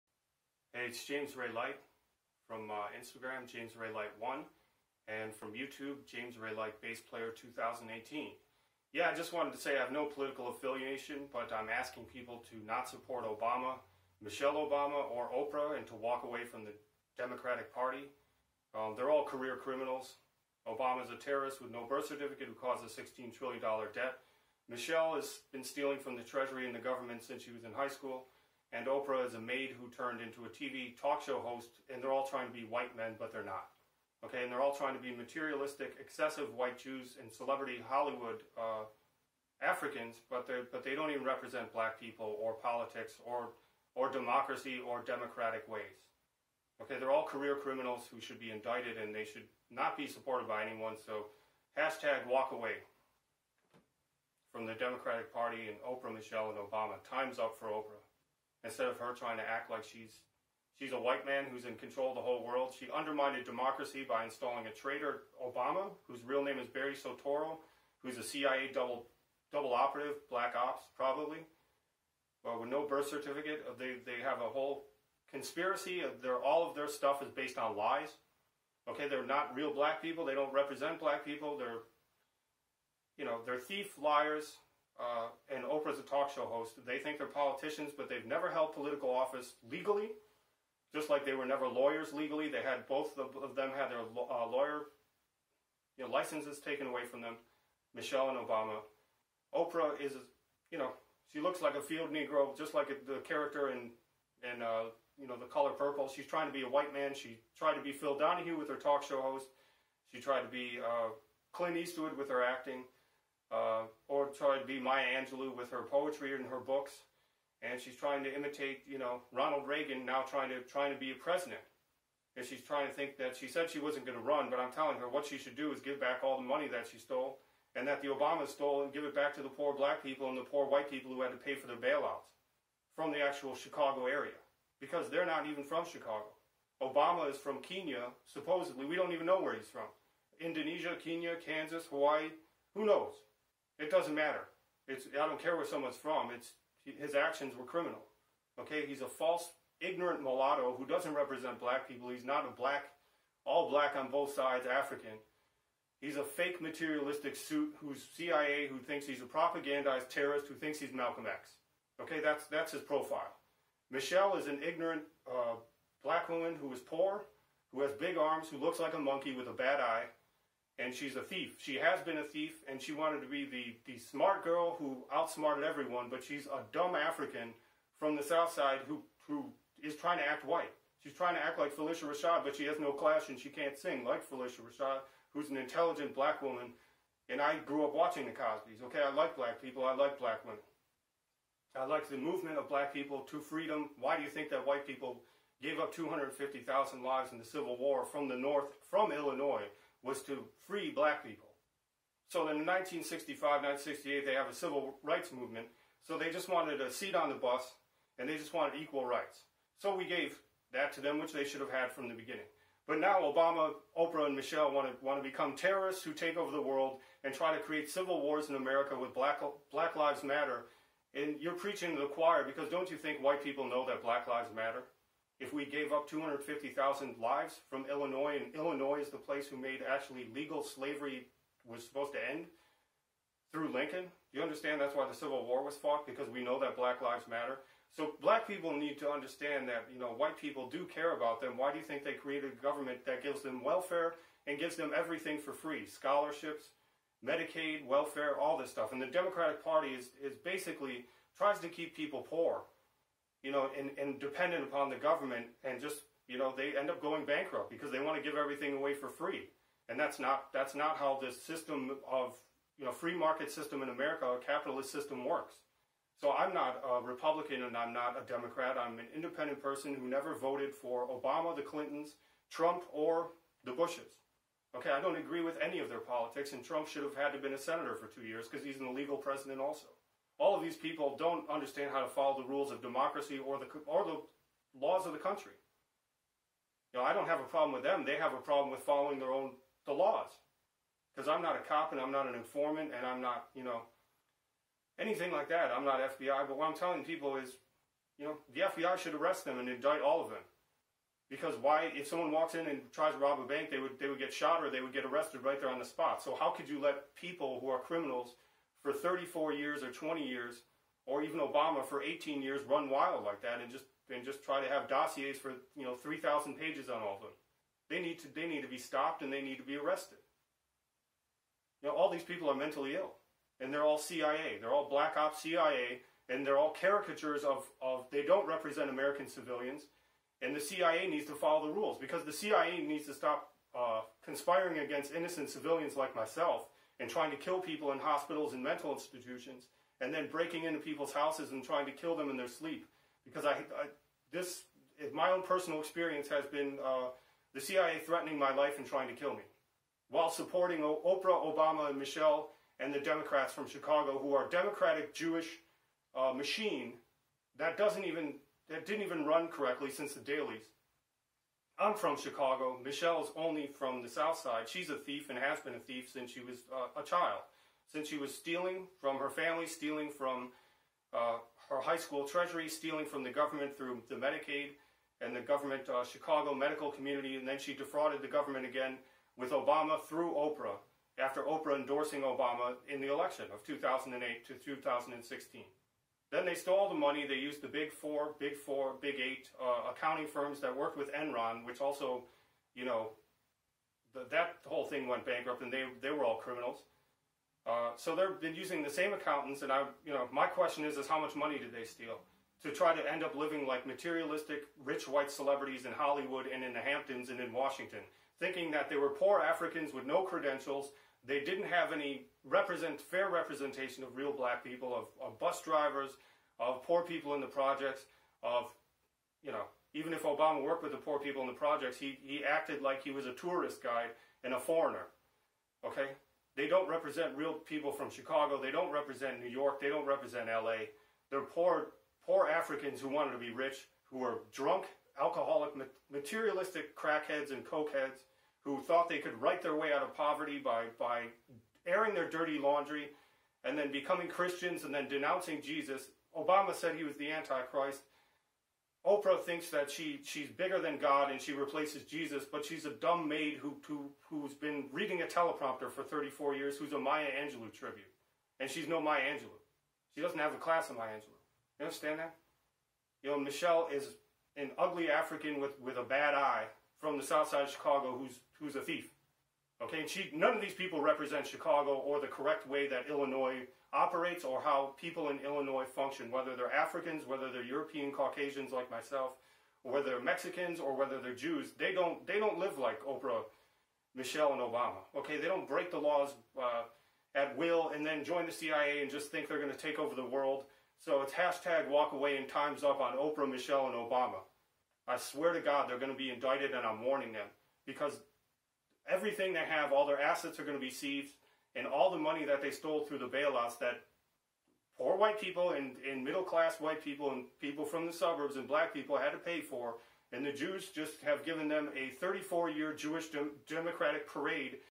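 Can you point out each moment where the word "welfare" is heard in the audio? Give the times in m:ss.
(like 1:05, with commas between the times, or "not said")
4:03, 4:07.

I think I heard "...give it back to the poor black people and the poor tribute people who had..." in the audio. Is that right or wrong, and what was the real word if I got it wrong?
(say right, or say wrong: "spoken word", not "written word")
wrong: "white", not "tribute".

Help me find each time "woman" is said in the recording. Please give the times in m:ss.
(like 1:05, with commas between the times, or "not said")
2:46, 3:06.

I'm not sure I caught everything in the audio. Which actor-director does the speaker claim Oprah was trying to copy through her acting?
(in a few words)
Clint Eastwood.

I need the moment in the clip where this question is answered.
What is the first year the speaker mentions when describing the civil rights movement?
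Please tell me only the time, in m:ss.
3:22.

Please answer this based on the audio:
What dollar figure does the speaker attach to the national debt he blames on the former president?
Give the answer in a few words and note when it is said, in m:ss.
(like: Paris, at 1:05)
$16 trillion, at 0:22.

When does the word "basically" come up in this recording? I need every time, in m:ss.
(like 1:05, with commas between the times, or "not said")
4:10.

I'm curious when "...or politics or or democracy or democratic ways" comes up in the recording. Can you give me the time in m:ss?
0:42.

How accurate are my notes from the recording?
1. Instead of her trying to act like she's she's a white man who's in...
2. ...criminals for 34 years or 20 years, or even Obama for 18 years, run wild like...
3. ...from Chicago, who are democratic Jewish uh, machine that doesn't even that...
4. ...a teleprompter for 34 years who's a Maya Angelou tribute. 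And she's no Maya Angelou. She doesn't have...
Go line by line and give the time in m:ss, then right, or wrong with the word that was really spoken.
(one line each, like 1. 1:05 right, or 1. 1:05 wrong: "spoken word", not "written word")
1. 0:58 right
2. 5:07 right
3. 5:53 right
4. 7:35 right.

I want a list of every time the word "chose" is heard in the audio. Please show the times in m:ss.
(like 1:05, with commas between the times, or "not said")
not said.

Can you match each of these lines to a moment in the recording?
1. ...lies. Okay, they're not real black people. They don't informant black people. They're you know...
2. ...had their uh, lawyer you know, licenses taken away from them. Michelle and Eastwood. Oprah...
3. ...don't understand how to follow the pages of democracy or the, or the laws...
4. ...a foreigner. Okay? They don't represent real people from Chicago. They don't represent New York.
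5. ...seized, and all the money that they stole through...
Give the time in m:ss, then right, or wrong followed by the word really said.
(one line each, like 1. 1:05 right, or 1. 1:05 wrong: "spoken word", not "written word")
1. 1:17 wrong: "represent", not "informant"
2. 1:33 wrong: "Obama", not "Eastwood"
3. 4:41 wrong: "rules", not "pages"
4. 7:04 right
5. 8:20 right.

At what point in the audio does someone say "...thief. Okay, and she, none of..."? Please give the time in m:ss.
7:48.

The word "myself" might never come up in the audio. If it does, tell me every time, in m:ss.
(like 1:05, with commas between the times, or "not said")
5:36, 7:58.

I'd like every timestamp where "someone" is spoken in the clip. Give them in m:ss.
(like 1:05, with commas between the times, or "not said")
2:25, 5:02.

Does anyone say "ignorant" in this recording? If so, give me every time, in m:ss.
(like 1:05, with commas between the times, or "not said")
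2:29, 2:44.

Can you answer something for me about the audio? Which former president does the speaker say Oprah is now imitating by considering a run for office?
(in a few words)
Ronald Reagan.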